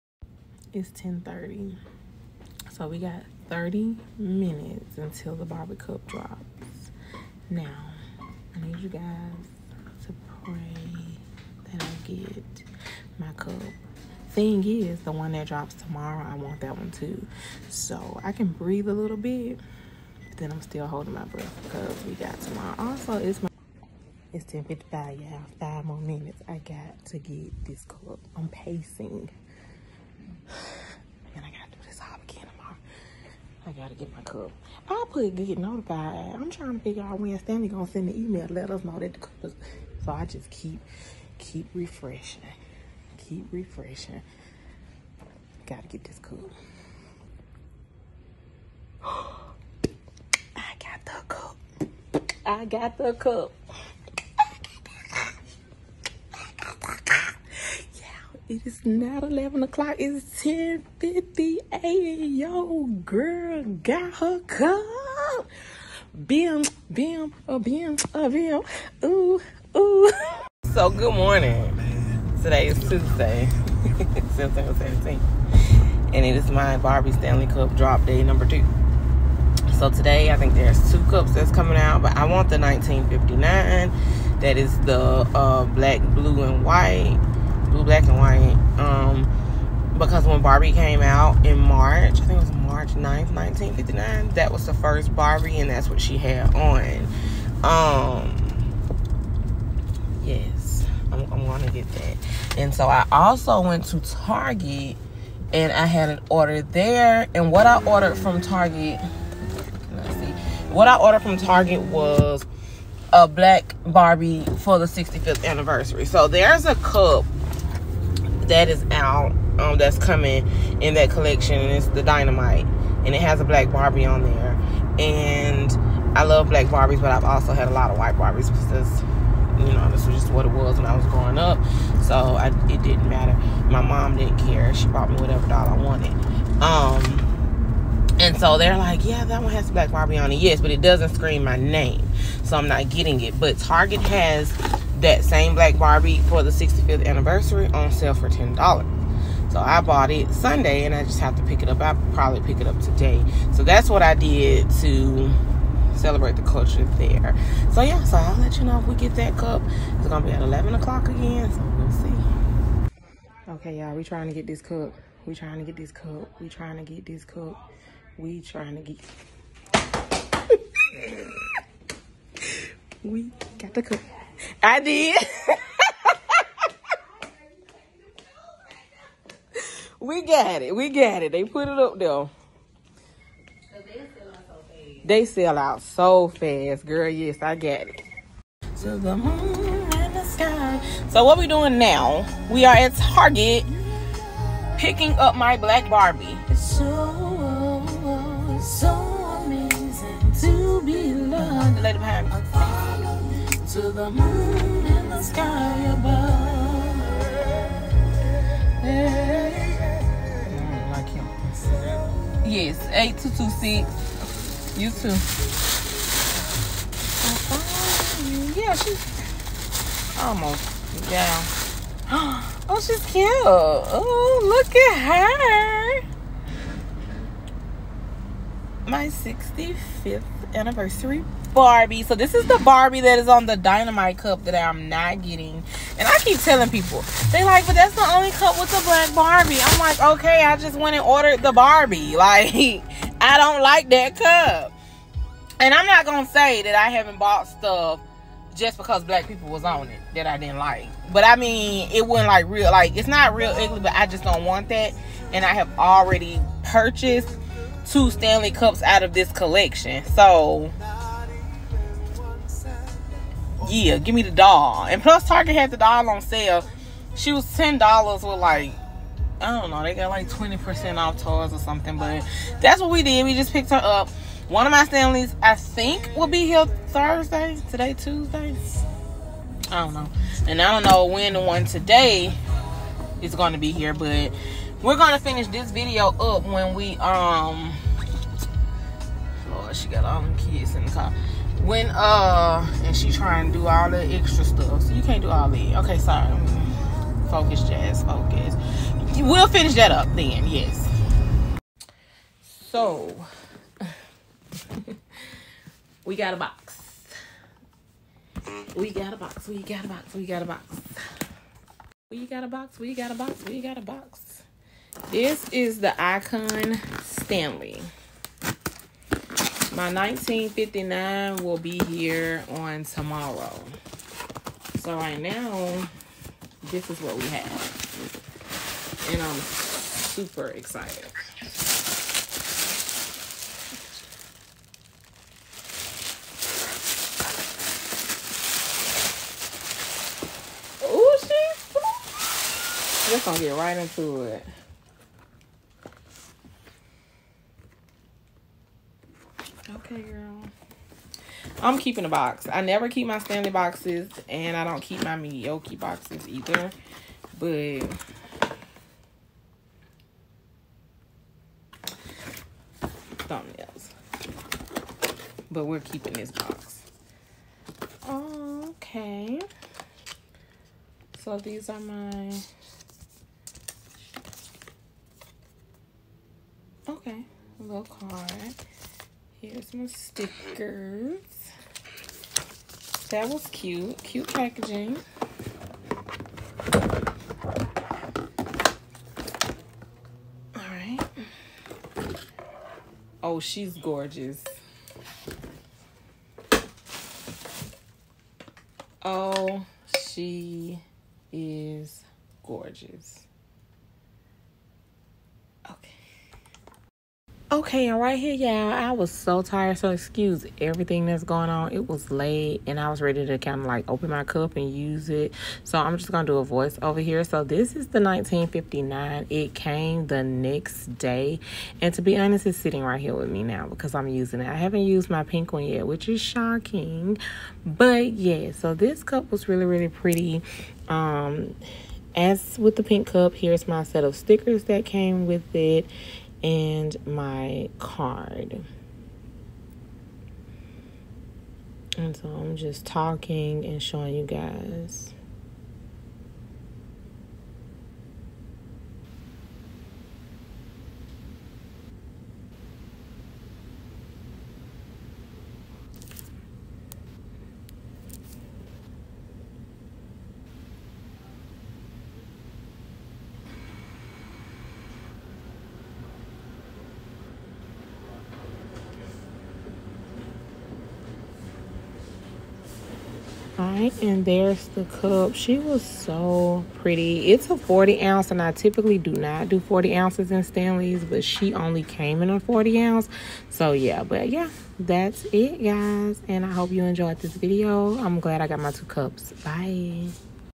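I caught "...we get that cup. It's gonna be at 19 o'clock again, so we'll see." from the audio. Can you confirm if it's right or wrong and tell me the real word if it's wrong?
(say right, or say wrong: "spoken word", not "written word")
wrong: "11", not "19".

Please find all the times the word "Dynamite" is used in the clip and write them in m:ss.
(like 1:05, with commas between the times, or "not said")
2:02, 3:53.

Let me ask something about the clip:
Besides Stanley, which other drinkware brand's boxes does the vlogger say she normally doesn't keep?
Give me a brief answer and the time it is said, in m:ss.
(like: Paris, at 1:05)
Meoky, at 5:55.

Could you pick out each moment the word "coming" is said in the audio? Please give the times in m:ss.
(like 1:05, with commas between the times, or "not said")
1:21, 1:59.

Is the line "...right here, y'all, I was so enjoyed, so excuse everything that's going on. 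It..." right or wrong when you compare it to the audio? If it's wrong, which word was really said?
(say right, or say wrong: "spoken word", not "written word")
wrong: "tired", not "enjoyed".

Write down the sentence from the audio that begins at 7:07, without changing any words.
But yeah, so this cup was really, really pretty.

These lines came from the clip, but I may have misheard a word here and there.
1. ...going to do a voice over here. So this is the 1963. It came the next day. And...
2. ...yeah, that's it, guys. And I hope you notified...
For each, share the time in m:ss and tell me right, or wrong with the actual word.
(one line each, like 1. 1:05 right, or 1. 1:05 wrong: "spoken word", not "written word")
1. 6:56 wrong: "1959", not "1963"
2. 8:04 wrong: "enjoyed", not "notified".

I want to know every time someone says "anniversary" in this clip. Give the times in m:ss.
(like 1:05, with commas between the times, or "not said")
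1:55, 2:27, 3:50.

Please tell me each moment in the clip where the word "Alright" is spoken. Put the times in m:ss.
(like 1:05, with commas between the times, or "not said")
6:30.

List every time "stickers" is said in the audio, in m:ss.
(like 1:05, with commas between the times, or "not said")
6:19, 7:14.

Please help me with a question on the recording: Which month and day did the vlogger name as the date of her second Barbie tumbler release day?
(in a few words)
September 17th.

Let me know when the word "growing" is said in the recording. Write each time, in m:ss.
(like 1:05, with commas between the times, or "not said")
2:11.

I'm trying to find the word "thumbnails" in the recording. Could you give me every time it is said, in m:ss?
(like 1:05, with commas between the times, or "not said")
6:03.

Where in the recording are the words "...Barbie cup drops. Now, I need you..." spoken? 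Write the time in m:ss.
0:05.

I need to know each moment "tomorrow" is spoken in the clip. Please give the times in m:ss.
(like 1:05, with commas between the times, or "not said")
0:15, 0:22, 5:22.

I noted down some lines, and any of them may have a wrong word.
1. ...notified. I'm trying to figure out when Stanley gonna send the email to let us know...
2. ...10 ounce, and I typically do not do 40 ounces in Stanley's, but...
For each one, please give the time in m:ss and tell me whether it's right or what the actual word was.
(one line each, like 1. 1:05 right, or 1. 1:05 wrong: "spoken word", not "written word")
1. 0:35 right
2. 7:57 wrong: "40", not "10".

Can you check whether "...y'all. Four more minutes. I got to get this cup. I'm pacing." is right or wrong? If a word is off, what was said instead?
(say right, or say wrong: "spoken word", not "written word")
wrong: "Five", not "Four".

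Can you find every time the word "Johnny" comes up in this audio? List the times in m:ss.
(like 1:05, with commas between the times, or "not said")
not said.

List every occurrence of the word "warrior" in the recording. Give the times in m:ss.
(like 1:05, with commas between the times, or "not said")
not said.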